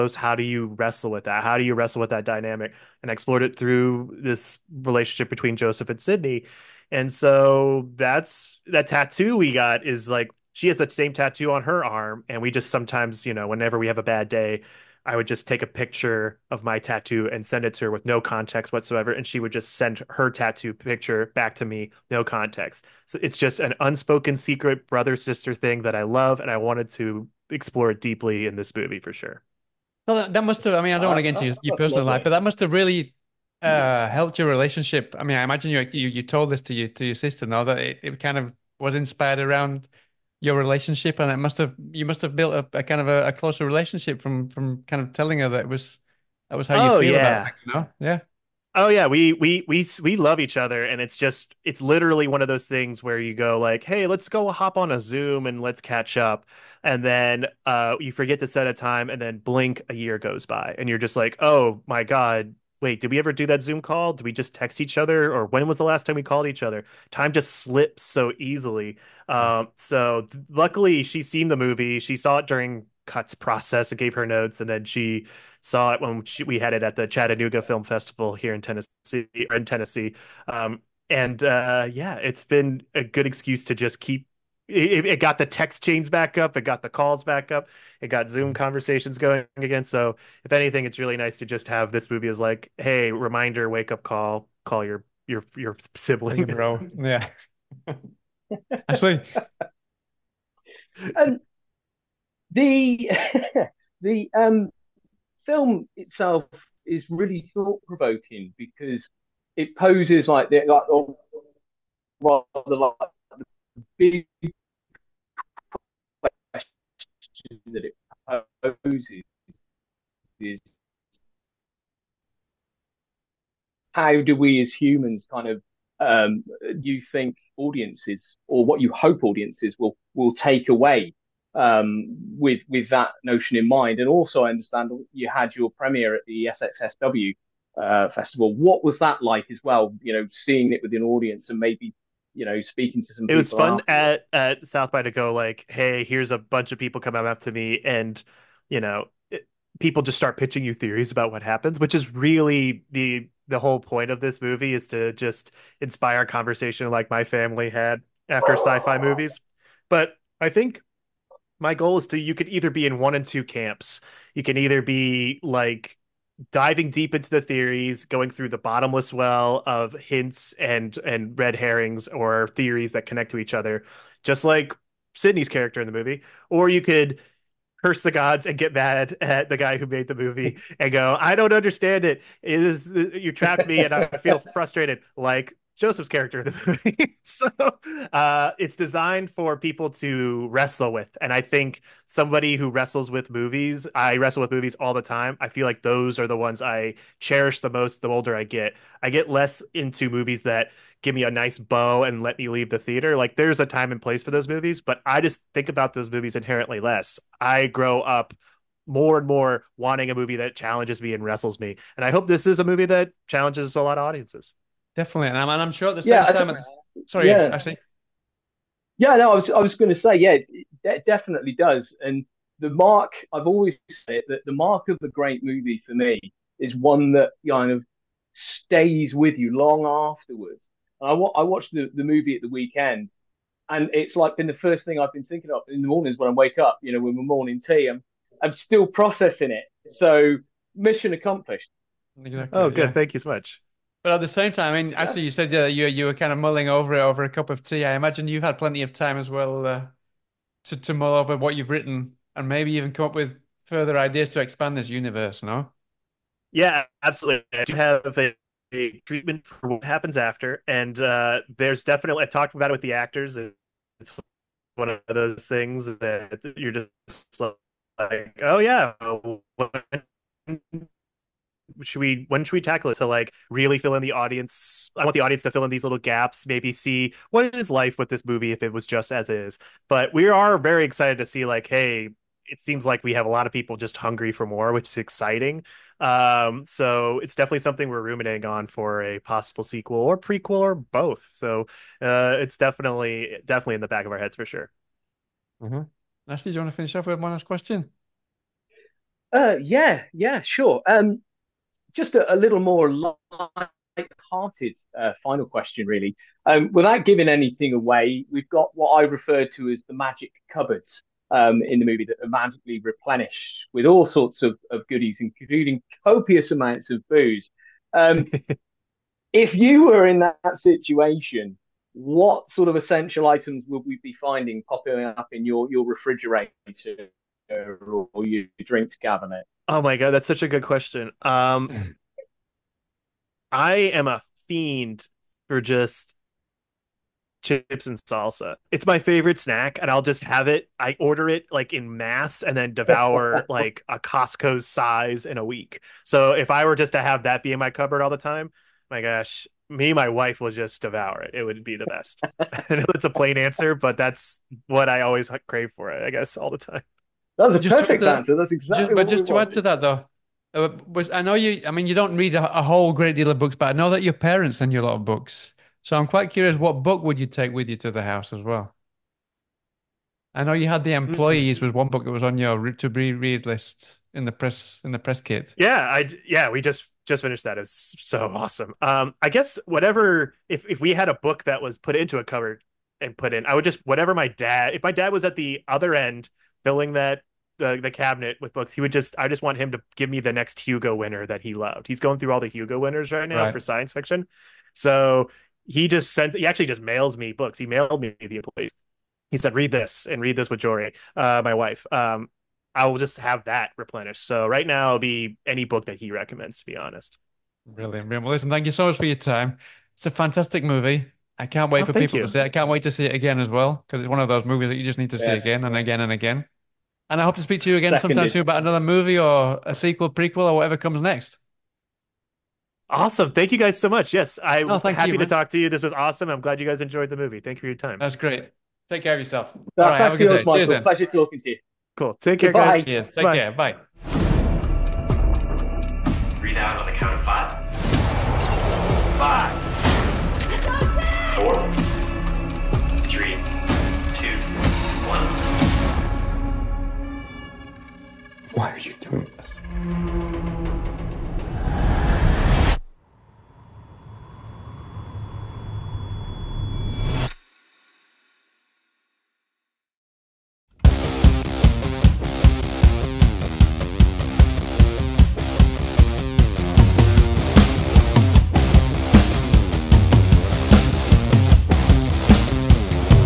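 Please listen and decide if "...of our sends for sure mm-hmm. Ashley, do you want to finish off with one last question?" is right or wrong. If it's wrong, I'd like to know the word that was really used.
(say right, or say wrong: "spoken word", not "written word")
wrong: "heads", not "sends".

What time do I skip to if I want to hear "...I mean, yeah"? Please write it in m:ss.
4:04.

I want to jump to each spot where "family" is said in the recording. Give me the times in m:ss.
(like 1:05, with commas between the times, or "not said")
2:37.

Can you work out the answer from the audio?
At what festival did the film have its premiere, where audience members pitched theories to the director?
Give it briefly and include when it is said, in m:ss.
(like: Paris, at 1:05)
SXSW, at 2:16.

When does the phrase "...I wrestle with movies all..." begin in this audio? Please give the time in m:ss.
3:13.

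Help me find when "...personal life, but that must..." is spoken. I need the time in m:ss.
0:31.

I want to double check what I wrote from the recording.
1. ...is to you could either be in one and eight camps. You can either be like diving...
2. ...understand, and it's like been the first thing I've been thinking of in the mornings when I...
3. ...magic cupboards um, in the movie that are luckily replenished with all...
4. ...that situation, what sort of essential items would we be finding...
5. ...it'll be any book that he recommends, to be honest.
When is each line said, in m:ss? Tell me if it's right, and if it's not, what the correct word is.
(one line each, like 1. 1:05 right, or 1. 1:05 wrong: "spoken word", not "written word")
1. 2:41 wrong: "two", not "eight"
2. 3:52 wrong: "weekend", not "understand"
3. 5:09 wrong: "magically", not "luckily"
4. 5:20 right
5. 6:44 right.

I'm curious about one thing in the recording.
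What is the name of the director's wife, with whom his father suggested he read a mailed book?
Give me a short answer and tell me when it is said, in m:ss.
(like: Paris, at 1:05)
Jory, at 6:40.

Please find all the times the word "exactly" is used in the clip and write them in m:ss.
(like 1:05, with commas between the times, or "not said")
4:02, 5:58.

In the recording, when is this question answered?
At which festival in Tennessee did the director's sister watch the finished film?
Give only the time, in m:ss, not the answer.
1:17.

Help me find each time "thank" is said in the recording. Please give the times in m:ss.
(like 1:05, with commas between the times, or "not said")
4:02, 6:48, 7:03, 7:07.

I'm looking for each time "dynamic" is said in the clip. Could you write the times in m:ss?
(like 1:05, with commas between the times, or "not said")
0:02.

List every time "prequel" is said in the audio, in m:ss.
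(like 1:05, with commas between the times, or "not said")
4:50, 7:00.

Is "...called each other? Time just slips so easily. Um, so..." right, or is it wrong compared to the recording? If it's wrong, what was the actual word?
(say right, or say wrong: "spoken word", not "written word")
right.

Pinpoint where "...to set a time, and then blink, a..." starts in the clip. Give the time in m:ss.
0:58.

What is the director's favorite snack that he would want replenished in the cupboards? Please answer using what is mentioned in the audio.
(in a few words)
Chips and salsa.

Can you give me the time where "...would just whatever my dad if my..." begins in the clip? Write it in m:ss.
6:23.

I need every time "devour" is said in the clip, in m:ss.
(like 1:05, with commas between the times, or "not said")
5:42, 5:50.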